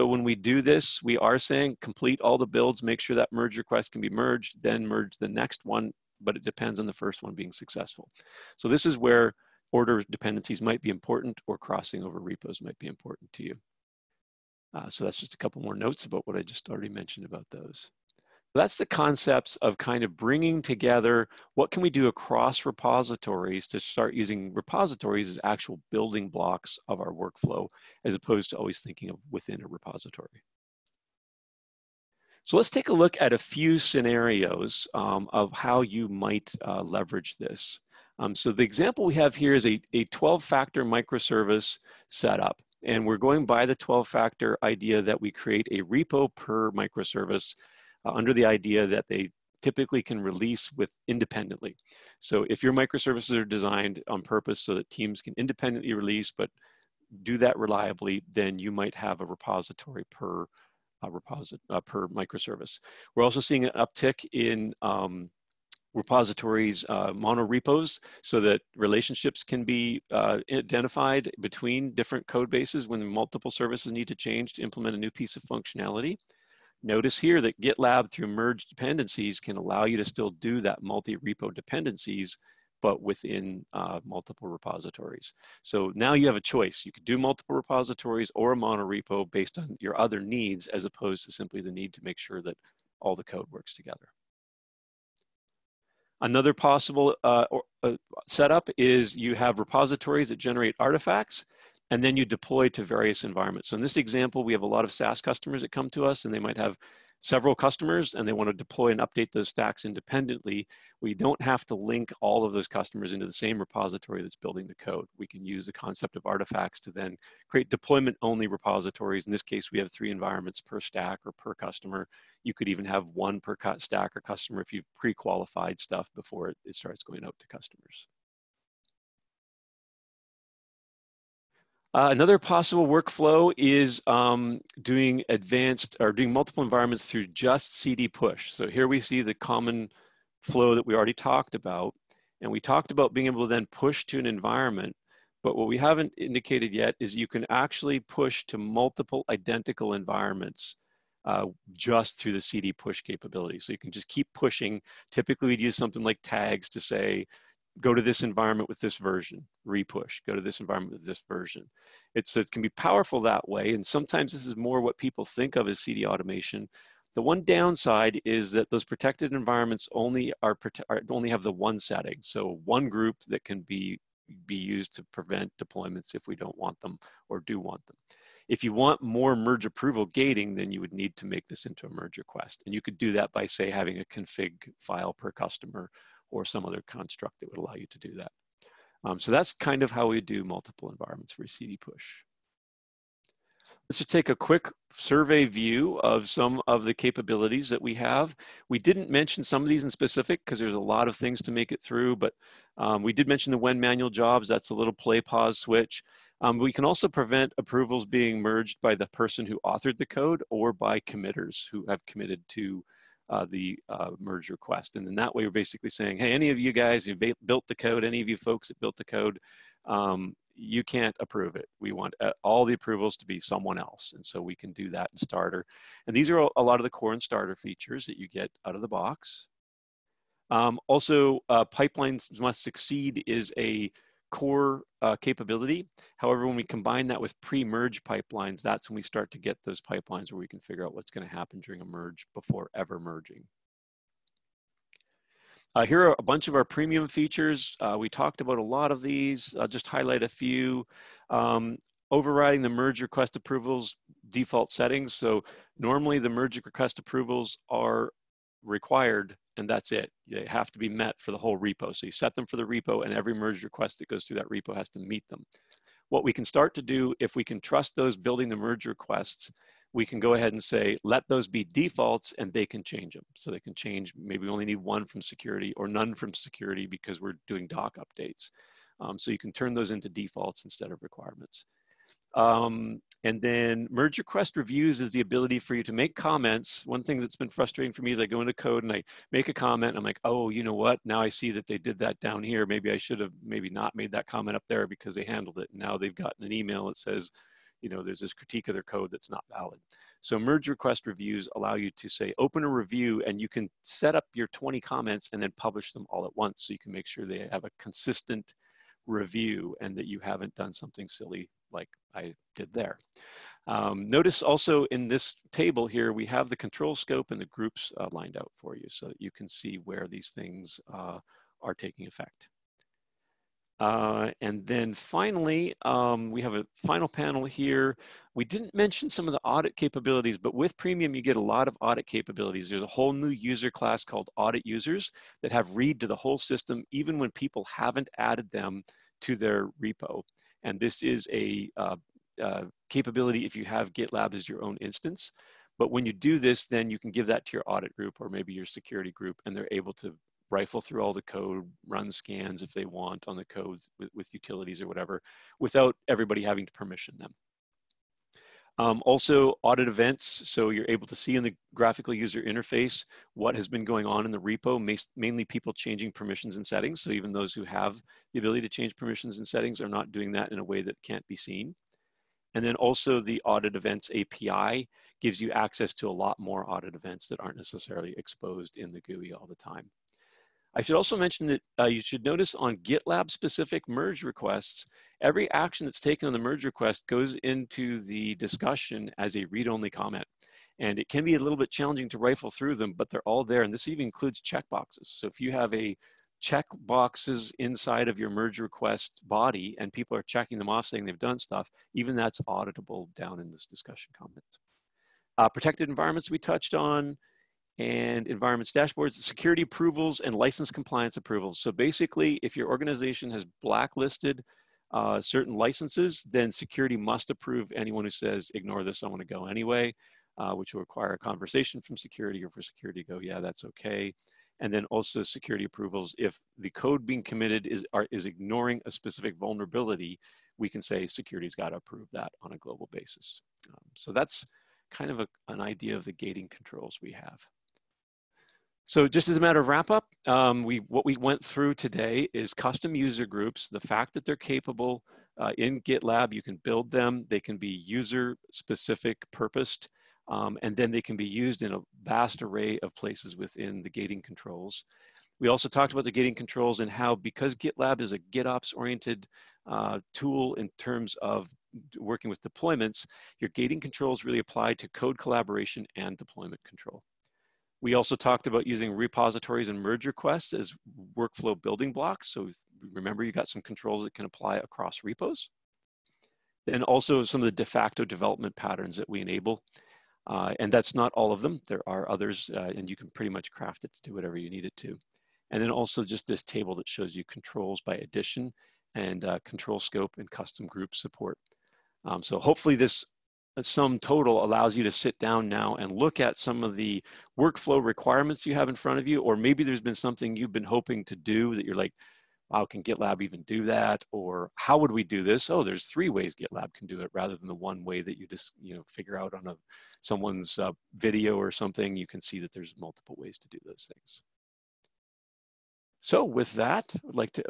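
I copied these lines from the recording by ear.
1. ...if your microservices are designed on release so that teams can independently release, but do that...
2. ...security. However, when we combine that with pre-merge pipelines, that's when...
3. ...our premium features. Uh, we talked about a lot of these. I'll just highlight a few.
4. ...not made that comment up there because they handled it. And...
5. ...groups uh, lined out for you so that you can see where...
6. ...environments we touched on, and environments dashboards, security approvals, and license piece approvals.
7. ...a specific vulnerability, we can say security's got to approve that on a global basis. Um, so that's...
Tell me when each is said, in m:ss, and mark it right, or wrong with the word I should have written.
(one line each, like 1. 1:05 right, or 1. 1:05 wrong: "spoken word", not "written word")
1. 0:52 wrong: "purpose", not "release"
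2. 3:55 wrong: "capability", not "security"
3. 4:06 right
4. 4:53 right
5. 5:17 right
6. 6:45 wrong: "compliance", not "piece"
7. 7:08 right.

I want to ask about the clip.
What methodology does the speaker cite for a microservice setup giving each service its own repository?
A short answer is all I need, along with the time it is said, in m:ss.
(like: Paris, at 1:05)
12-factor, at 0:39.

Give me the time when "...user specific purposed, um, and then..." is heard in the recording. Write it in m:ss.
7:27.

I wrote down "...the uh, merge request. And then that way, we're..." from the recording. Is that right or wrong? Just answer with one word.
right.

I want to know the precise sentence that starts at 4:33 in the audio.
So they can change, maybe we only need one from security or none from security because we're doing doc updates.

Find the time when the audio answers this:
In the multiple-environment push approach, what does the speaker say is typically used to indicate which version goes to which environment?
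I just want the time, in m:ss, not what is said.
2:36.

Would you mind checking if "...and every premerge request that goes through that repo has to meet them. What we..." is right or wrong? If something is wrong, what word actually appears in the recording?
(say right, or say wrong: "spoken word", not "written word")
wrong: "merge", not "premerge".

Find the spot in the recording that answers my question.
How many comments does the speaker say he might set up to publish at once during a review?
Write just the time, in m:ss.
5:04.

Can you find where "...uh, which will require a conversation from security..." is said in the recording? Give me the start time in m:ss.
7:00.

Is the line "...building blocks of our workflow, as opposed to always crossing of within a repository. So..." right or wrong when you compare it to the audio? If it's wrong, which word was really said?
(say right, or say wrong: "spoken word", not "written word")
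wrong: "thinking", not "crossing".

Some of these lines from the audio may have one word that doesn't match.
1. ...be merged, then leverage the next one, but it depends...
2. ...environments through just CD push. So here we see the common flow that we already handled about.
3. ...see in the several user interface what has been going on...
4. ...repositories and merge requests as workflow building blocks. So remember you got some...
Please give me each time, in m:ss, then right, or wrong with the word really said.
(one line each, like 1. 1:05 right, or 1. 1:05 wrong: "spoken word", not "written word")
1. 0:04 wrong: "merge", not "leverage"
2. 2:16 wrong: "talked", not "handled"
3. 6:01 wrong: "graphical", not "several"
4. 7:48 right.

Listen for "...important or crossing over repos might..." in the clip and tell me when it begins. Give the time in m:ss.
0:10.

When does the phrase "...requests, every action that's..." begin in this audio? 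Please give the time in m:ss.
6:24.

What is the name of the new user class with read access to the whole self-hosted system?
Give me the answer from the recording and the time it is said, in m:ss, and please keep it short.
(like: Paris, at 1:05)
audit users, at 5:34.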